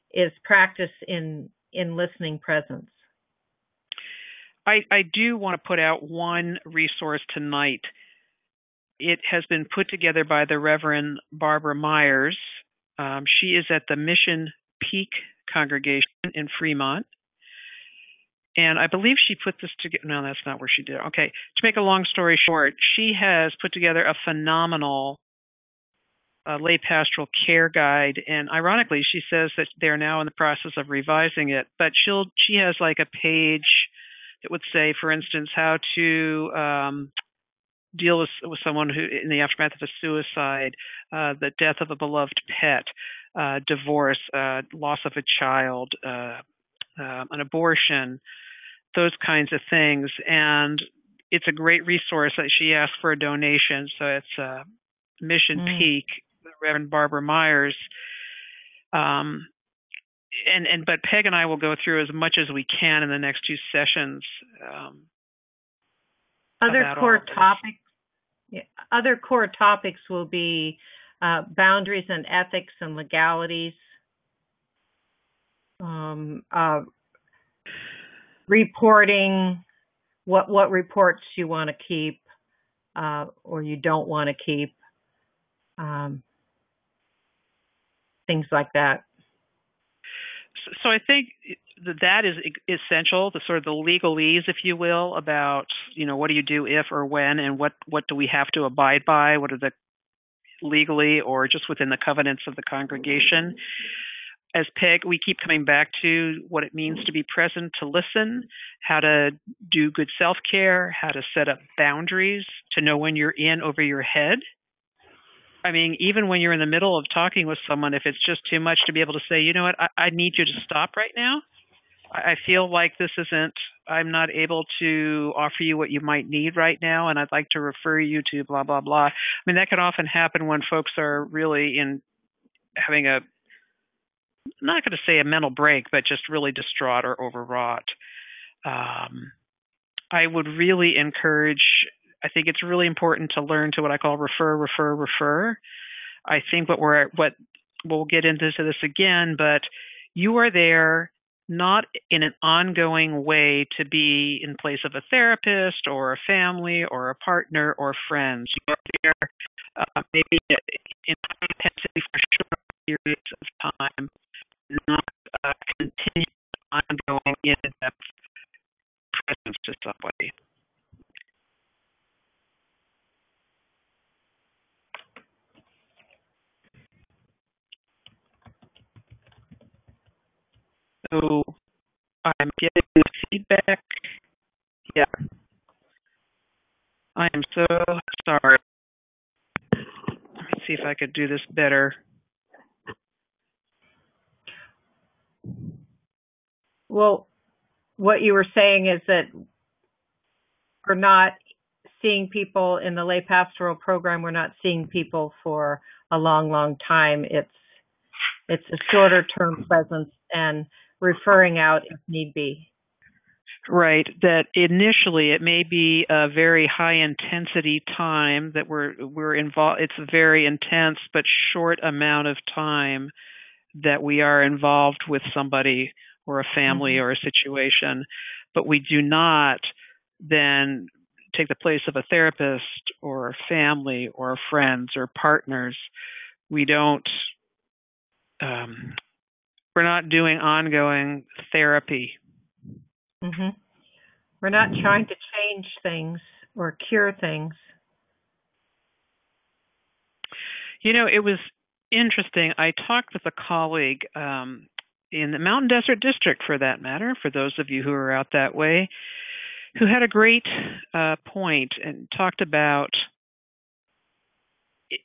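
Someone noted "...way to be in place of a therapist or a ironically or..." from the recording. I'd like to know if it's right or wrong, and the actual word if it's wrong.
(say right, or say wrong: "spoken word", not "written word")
wrong: "family", not "ironically".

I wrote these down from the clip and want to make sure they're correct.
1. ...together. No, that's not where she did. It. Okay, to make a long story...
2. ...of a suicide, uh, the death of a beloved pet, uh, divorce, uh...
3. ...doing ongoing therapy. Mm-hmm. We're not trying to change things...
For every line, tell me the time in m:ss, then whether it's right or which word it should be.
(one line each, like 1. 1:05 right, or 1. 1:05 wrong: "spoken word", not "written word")
1. 0:19 right
2. 0:39 right
3. 4:00 right.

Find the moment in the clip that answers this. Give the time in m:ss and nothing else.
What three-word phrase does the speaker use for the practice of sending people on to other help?
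2:24.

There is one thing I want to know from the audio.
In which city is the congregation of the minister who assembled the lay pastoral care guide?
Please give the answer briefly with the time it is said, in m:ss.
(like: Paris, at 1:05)
Fremont, at 0:16.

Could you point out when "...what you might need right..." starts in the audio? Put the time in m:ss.
2:05.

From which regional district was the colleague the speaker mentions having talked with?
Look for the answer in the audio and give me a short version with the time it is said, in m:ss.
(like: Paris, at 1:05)
Mountain Desert District, at 4:15.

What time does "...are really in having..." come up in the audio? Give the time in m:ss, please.
2:10.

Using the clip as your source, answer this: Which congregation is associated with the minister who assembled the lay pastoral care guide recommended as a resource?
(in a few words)
Mission Peak.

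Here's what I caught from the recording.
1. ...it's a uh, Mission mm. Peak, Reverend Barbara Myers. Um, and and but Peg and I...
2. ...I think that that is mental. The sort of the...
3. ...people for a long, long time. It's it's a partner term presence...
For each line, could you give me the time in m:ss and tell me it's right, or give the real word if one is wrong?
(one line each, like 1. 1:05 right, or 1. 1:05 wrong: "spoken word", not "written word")
1. 0:54 right
2. 1:30 wrong: "essential", not "mental"
3. 3:24 wrong: "shorter", not "partner".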